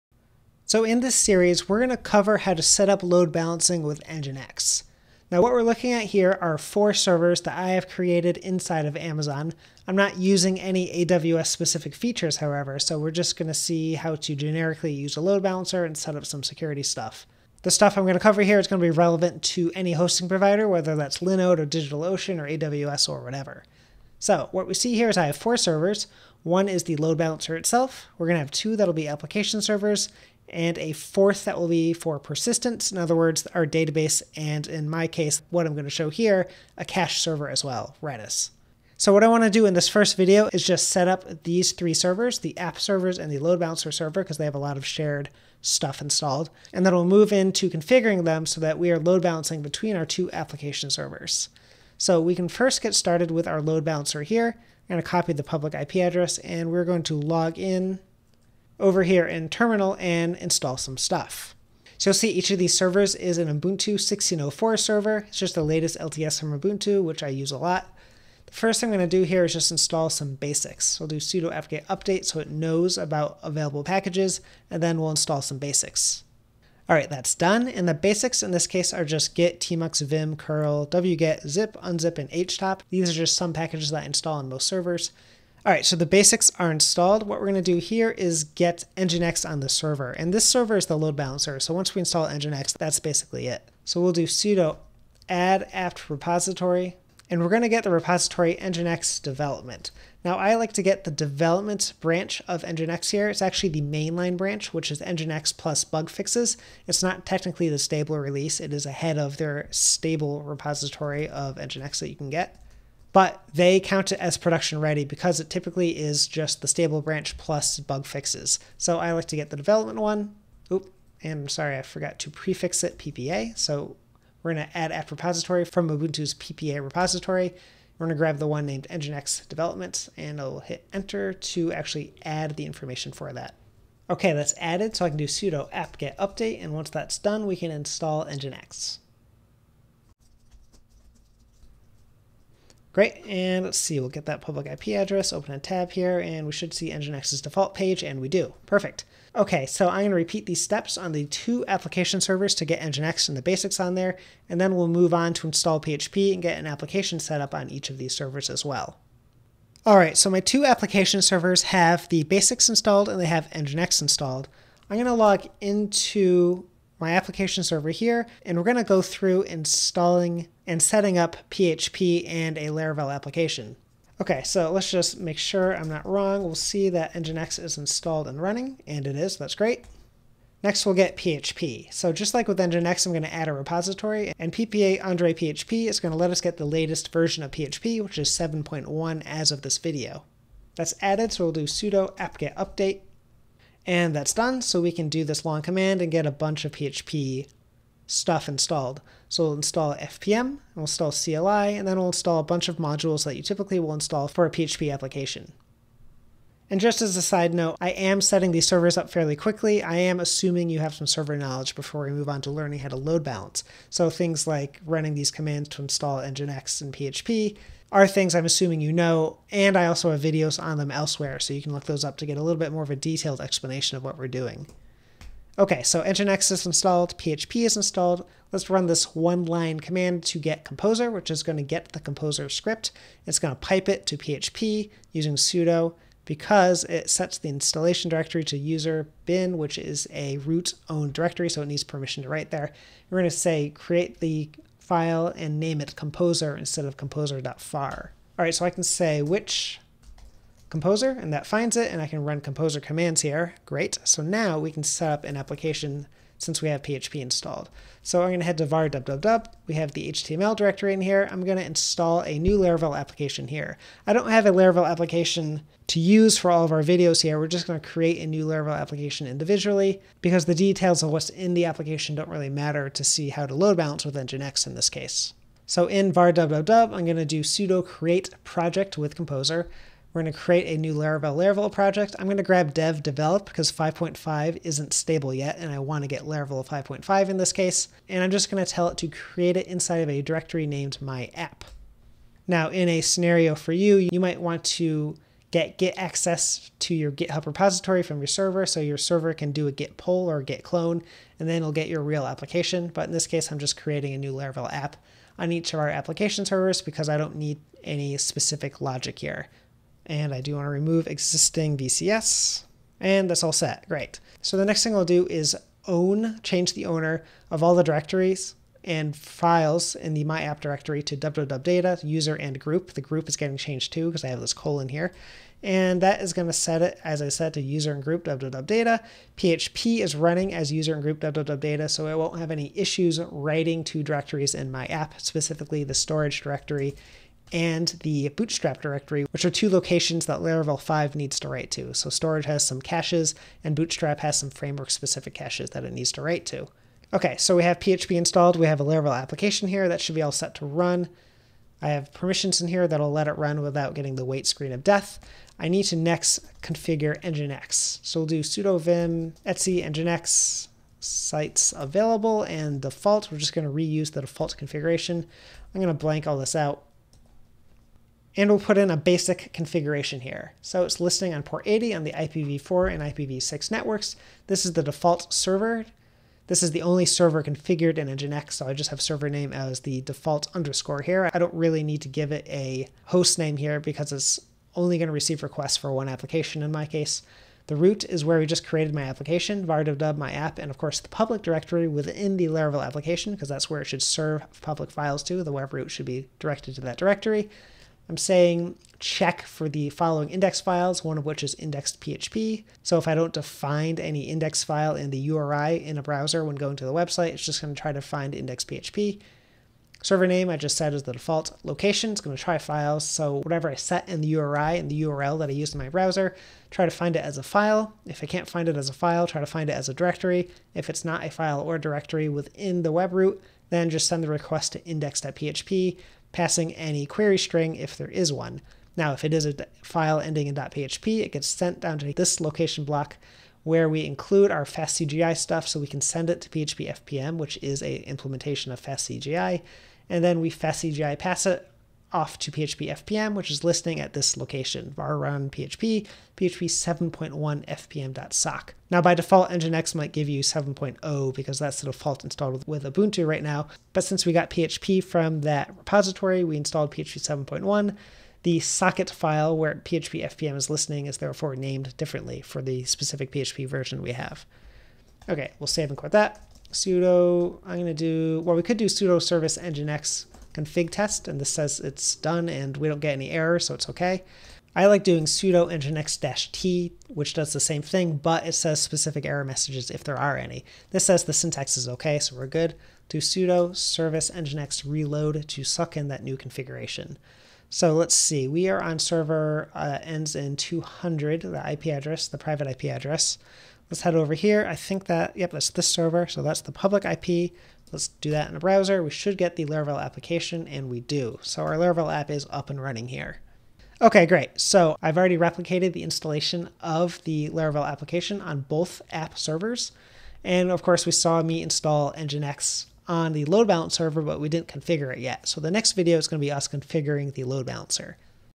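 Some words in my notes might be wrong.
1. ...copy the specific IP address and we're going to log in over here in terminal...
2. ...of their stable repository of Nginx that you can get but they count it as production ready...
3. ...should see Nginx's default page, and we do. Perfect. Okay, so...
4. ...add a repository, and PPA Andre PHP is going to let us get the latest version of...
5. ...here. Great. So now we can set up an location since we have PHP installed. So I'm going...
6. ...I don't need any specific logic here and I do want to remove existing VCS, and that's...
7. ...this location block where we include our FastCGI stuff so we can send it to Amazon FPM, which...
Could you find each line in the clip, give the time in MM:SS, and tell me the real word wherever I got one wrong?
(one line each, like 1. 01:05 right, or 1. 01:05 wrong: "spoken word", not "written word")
1. 00:55 wrong: "public", not "specific"
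2. 01:49 right
3. 02:26 right
4. 03:03 right
5. 04:13 wrong: "application", not "location"
6. 05:07 right
7. 07:12 wrong: "PHP", not "Amazon".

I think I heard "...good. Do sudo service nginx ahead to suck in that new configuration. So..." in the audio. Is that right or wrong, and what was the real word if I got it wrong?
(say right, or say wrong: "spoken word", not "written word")
wrong: "reload", not "ahead".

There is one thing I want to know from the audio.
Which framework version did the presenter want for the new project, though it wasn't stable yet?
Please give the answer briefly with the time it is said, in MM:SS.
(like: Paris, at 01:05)
Laravel 5.5, at 04:46.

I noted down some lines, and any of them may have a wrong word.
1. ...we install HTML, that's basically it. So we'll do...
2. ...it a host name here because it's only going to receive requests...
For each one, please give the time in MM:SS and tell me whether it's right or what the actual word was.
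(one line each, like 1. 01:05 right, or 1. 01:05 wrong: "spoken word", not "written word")
1. 01:31 wrong: "Nginx", not "HTML"
2. 06:22 right.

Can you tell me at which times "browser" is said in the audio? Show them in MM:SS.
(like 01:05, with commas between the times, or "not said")
06:46, 06:55, 08:18.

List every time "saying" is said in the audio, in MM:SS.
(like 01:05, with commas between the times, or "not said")
06:38.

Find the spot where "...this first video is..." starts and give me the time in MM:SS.
00:39.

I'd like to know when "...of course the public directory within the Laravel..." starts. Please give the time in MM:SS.
06:30.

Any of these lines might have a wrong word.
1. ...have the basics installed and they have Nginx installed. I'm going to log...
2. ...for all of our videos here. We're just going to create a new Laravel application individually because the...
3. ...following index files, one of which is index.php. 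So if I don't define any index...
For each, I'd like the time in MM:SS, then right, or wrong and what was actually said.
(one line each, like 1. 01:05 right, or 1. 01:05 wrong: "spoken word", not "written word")
1. 02:41 right
2. 04:26 right
3. 06:39 right.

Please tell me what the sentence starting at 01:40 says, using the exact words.
Now I like to get the development branch of Nginx here.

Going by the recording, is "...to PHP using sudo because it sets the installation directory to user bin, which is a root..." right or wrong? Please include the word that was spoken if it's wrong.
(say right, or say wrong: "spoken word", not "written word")
right.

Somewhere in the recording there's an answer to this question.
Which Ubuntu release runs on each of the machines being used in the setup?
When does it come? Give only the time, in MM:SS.
01:03.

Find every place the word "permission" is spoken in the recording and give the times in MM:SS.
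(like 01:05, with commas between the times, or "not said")
04:01, 05:52.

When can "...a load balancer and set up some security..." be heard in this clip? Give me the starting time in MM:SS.
00:15.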